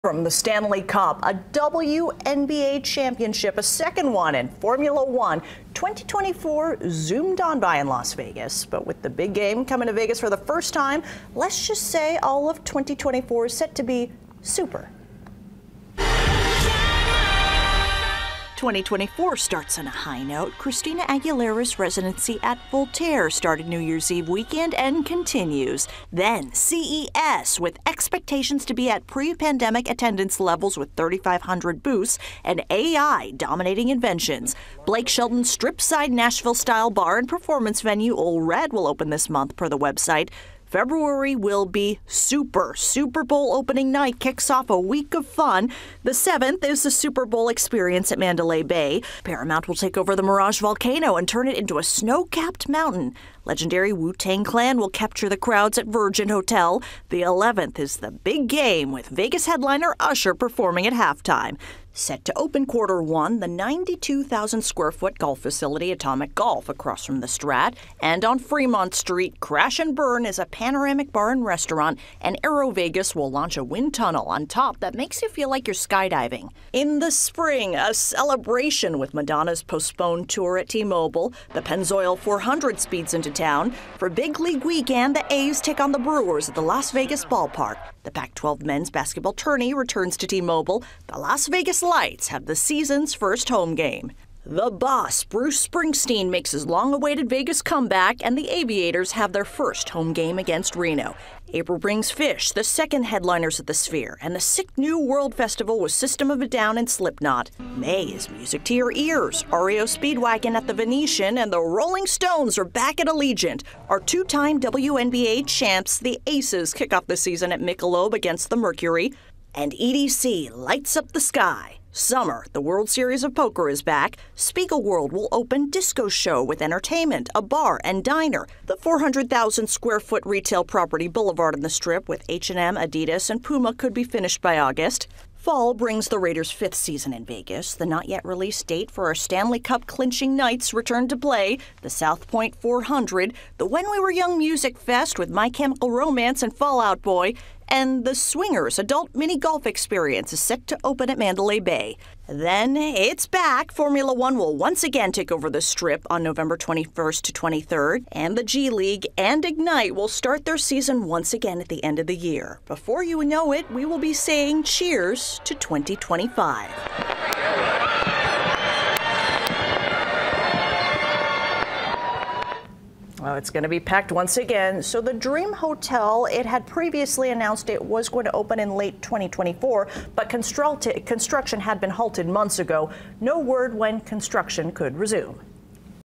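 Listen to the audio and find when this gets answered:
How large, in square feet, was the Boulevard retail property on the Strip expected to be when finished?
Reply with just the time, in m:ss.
2:08.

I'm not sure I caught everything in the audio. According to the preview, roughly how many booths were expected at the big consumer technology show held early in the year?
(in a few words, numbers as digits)
3,500.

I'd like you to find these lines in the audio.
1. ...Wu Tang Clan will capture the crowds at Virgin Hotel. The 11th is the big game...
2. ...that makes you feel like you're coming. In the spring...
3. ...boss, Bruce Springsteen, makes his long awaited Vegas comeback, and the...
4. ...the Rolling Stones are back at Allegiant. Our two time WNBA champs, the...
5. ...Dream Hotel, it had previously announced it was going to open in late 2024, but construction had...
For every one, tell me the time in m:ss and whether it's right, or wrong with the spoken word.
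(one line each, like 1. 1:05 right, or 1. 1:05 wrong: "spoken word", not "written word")
1. 0:53 right
2. 1:14 wrong: "skydiving", not "coming"
3. 1:34 right
4. 1:51 right
5. 2:55 right.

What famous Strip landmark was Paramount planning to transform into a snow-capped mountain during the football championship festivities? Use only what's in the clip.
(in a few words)
Mirage Volcano.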